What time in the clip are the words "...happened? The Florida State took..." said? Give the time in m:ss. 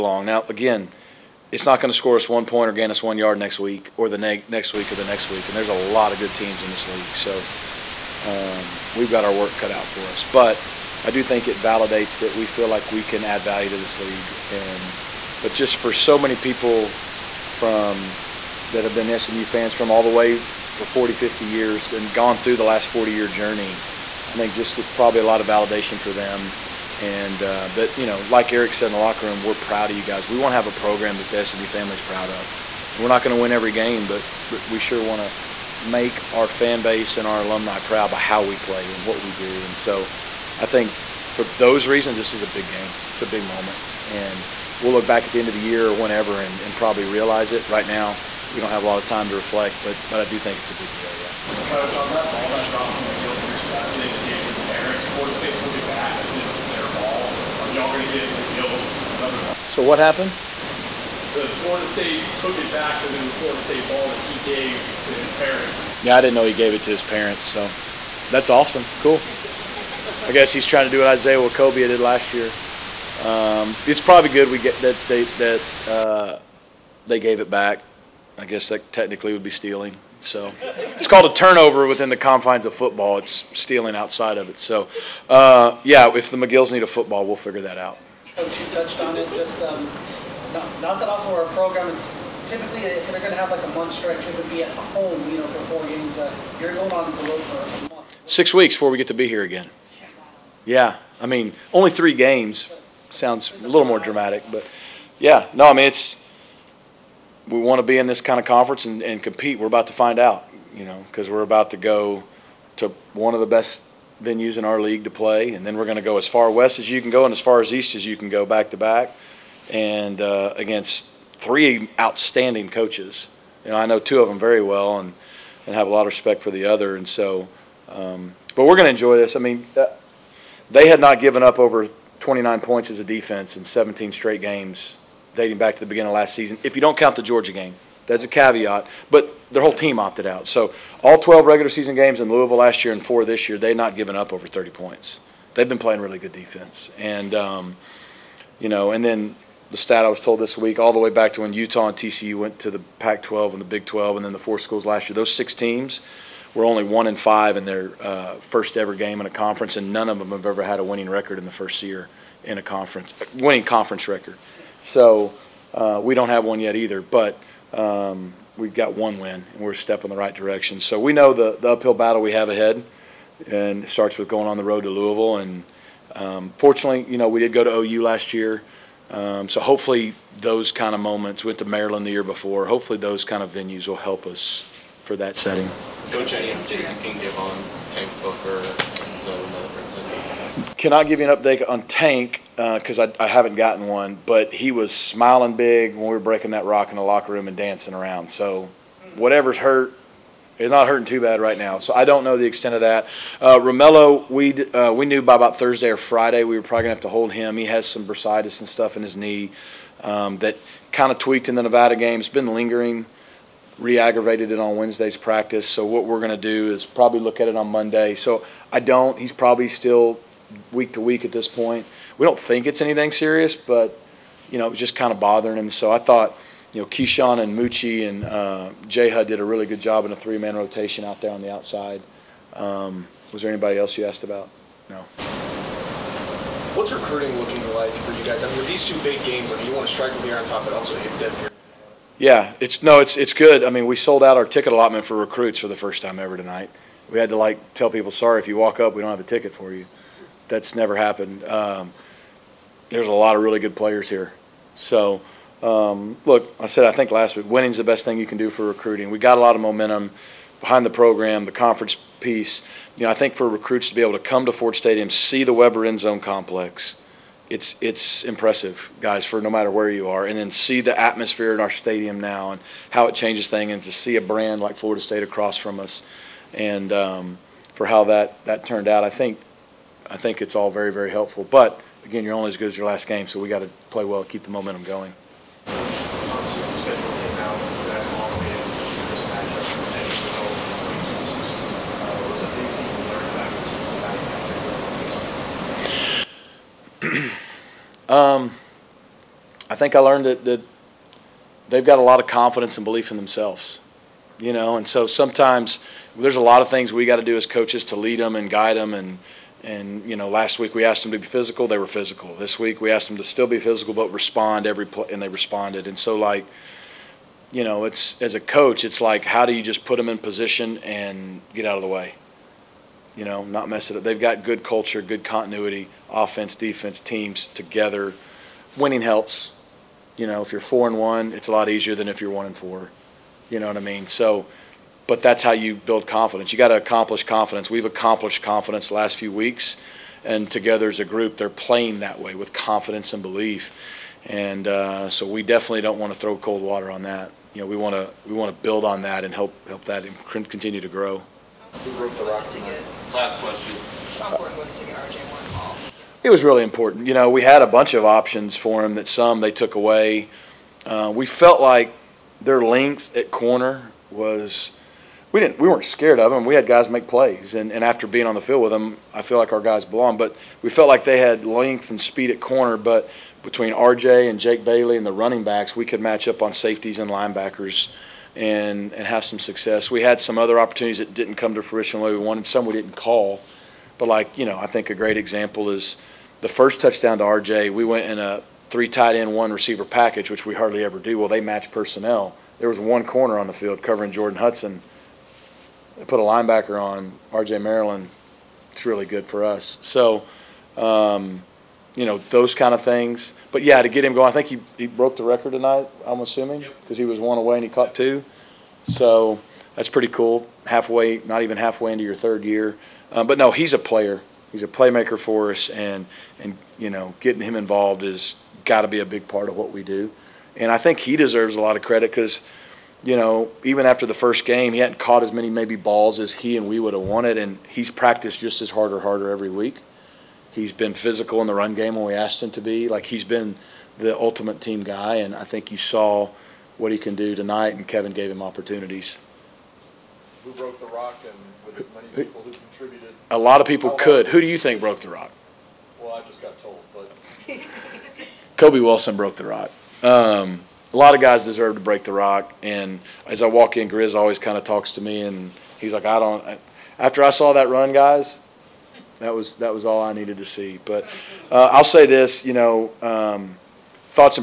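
0:59.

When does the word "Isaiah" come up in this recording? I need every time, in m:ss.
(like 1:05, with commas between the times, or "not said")
1:11.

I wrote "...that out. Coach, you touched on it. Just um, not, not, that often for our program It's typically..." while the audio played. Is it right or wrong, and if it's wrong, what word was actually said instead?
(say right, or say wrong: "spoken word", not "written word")
right.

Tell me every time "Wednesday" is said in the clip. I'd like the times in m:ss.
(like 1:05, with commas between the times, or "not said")
3:34.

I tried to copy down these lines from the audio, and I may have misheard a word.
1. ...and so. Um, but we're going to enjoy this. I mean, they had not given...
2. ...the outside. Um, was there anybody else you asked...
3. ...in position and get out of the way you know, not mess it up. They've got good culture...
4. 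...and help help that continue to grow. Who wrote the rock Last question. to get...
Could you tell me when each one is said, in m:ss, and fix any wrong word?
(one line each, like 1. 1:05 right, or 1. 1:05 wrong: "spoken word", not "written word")
1. 2:06 right
2. 3:51 right
3. 5:20 right
4. 5:49 right.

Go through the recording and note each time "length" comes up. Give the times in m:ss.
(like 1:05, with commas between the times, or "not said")
6:02, 6:11.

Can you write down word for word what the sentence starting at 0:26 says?
And uh, that, you know, like Eric said in the locker room, we're proud of you guys.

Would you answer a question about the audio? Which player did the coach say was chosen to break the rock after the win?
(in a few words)
Kobe Wilson.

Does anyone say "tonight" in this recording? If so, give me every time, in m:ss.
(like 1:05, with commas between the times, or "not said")
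4:06, 6:45, 7:17.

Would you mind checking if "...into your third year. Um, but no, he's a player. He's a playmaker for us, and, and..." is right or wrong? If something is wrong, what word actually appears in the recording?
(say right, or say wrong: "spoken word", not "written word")
right.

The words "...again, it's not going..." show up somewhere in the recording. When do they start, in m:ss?
0:00.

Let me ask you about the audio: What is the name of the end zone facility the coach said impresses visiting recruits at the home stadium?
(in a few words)
Weber End Zone Complex.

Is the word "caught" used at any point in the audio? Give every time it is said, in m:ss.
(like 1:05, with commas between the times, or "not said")
6:47, 7:04.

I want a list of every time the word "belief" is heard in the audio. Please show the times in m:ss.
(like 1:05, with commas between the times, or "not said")
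5:02, 5:43.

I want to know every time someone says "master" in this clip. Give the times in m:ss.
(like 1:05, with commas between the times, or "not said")
not said.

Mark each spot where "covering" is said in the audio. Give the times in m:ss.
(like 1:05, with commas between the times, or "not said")
6:33.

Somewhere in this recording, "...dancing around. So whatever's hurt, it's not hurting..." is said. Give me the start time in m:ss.
3:17.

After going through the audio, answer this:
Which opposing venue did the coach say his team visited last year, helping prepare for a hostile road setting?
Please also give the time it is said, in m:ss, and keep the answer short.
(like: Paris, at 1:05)
OU, at 2:57.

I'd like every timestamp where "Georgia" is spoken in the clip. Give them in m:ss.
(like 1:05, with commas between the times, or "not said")
2:17.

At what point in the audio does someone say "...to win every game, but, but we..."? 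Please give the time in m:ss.
0:33.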